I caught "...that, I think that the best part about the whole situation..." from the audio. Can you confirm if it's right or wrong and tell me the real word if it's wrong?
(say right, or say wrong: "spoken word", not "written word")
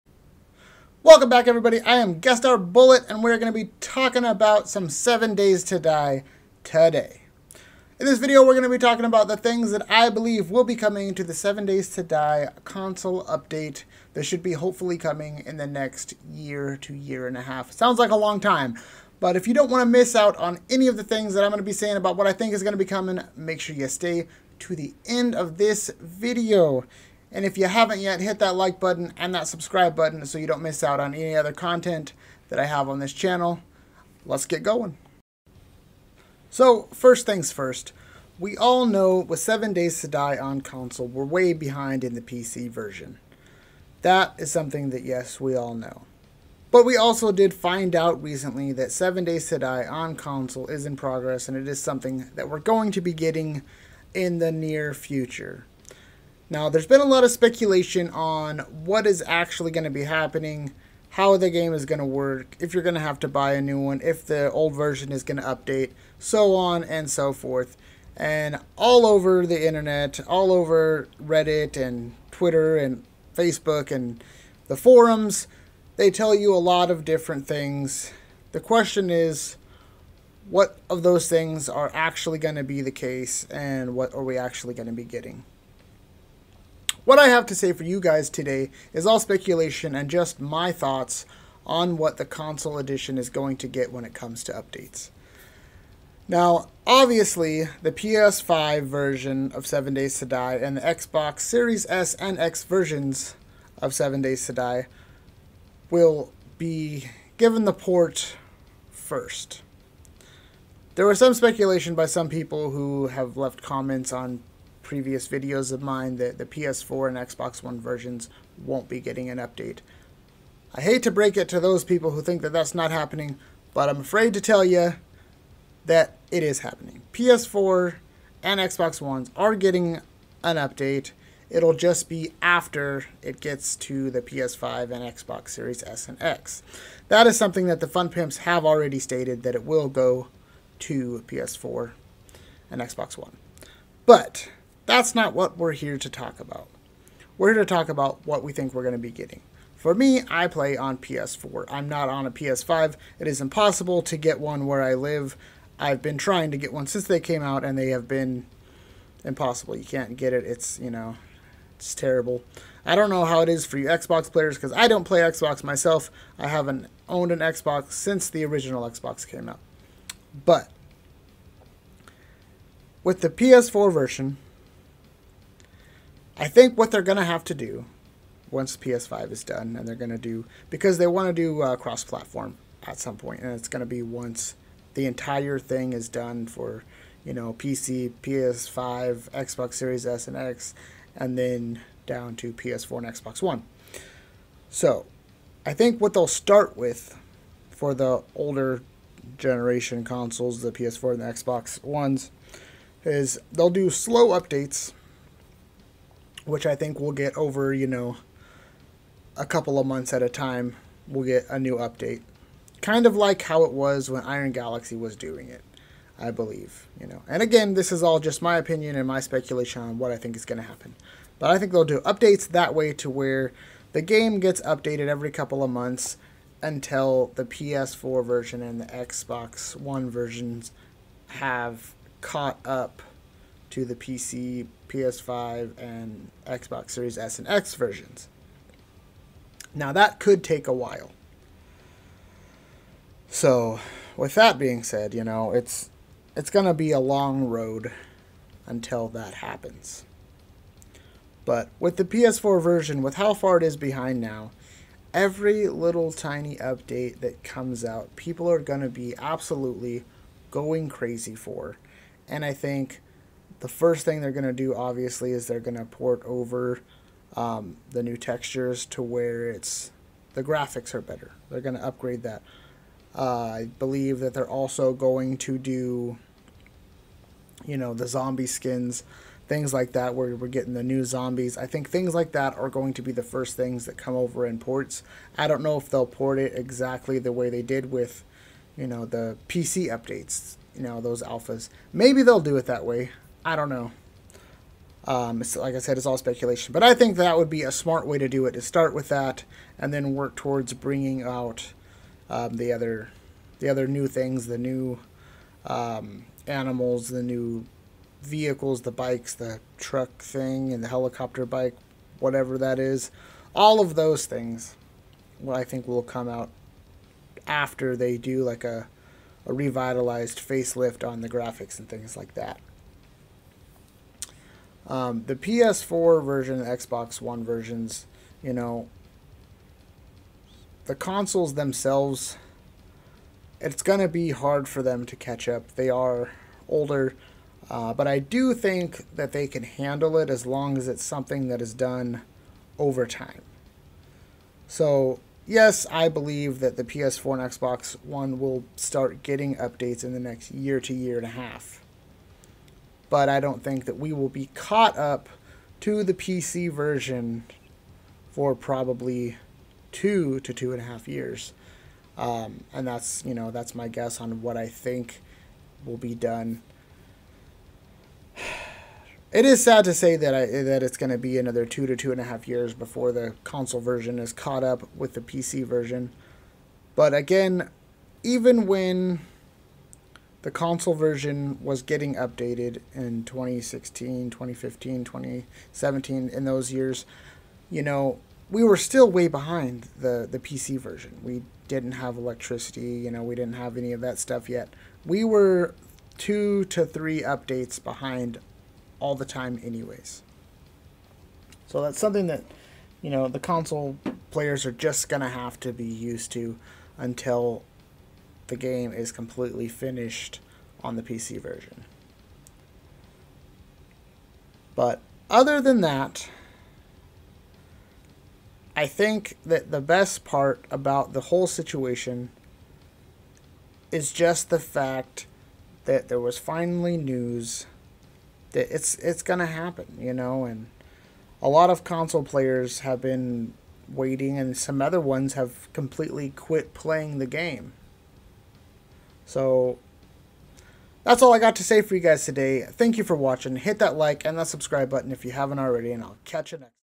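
right.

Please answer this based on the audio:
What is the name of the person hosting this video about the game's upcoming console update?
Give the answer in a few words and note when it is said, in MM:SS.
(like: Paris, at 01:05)
GuestStarBullet, at 00:02.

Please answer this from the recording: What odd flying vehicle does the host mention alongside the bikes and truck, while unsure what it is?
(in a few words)
Helicopter bike.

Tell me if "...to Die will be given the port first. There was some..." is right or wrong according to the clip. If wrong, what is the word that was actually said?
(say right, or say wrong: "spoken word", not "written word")
right.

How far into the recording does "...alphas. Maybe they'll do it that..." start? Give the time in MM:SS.
04:51.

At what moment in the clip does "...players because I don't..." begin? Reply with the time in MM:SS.
02:44.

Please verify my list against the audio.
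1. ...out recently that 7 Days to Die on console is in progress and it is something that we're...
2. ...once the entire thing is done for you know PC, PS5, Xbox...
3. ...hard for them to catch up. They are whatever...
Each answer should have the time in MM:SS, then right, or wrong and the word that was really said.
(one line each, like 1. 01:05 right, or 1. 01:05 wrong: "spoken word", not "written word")
1. 00:47 right
2. 03:04 right
3. 05:34 wrong: "older", not "whatever".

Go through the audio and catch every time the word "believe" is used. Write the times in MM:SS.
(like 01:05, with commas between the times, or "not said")
00:10, 03:36, 04:33, 05:46.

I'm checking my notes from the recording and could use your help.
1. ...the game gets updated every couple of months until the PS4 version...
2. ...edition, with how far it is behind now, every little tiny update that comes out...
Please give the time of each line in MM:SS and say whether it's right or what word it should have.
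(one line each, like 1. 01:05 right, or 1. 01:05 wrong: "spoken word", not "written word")
1. 03:43 right
2. 04:12 wrong: "version", not "edition".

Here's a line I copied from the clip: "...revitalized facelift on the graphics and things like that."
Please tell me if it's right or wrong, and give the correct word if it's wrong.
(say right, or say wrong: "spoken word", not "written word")
right.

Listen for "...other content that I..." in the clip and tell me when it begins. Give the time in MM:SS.
00:31.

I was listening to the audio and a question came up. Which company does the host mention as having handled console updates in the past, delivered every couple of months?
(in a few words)
Iron Galaxy.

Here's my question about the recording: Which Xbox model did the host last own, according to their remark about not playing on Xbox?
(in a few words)
Original Xbox.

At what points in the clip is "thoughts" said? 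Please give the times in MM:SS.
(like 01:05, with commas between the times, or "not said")
01:30.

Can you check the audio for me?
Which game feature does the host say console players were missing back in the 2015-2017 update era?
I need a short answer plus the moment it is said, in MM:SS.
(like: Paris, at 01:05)
Electricity, at 06:32.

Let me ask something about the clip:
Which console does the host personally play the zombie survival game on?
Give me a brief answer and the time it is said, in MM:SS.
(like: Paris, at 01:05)
PS4, at 02:30.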